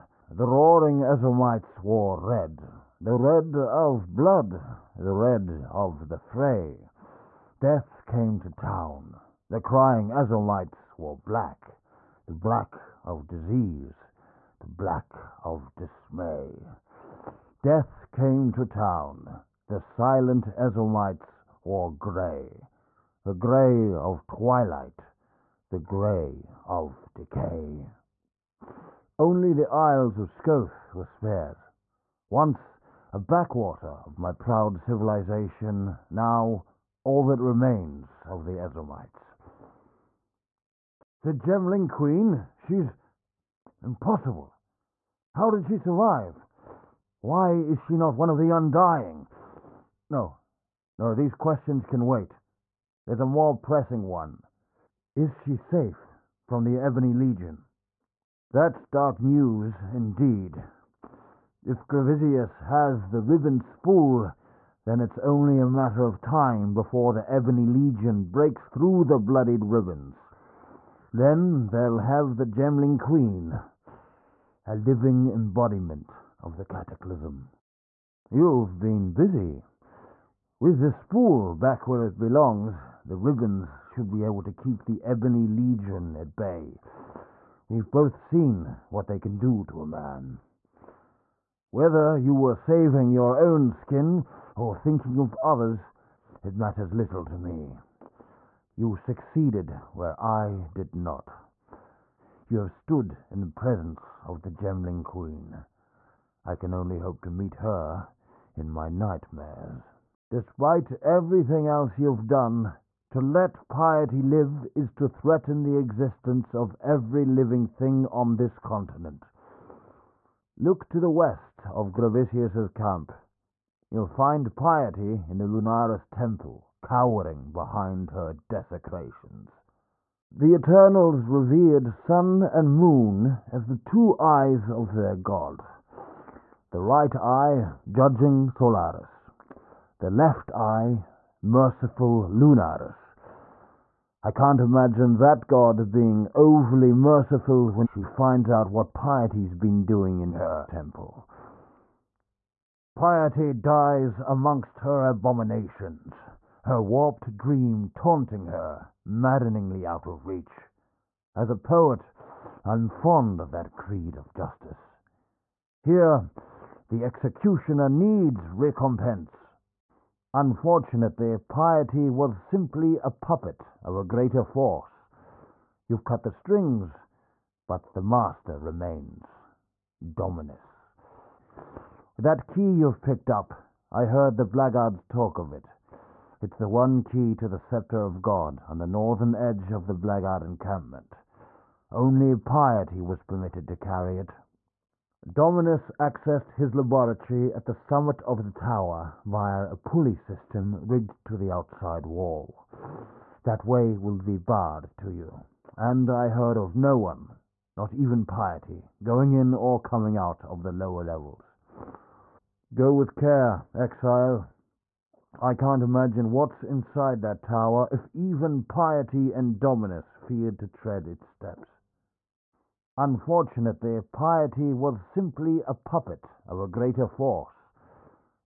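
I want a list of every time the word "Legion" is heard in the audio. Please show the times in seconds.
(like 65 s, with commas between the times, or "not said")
57 s, 67 s, 85 s.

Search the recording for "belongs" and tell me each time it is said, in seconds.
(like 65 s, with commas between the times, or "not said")
82 s.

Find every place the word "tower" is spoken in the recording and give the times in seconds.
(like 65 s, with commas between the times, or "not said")
198 s, 217 s.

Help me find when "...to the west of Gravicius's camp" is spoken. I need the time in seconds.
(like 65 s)
120 s.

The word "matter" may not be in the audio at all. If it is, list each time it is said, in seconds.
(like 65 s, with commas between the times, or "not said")
65 s, 96 s.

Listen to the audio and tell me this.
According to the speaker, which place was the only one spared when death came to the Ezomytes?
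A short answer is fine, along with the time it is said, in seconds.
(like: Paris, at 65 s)
Isles of Scoth, at 29 s.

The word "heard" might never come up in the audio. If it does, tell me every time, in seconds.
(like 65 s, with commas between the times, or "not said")
184 s, 206 s.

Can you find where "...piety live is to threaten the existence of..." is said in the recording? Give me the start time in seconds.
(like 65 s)
113 s.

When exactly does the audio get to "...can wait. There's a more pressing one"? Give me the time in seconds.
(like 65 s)
51 s.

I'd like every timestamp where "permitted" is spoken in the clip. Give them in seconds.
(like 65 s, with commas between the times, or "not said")
193 s.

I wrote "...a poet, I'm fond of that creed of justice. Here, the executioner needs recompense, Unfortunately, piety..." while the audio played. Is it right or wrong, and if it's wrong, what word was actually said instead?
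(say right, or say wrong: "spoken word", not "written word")
right.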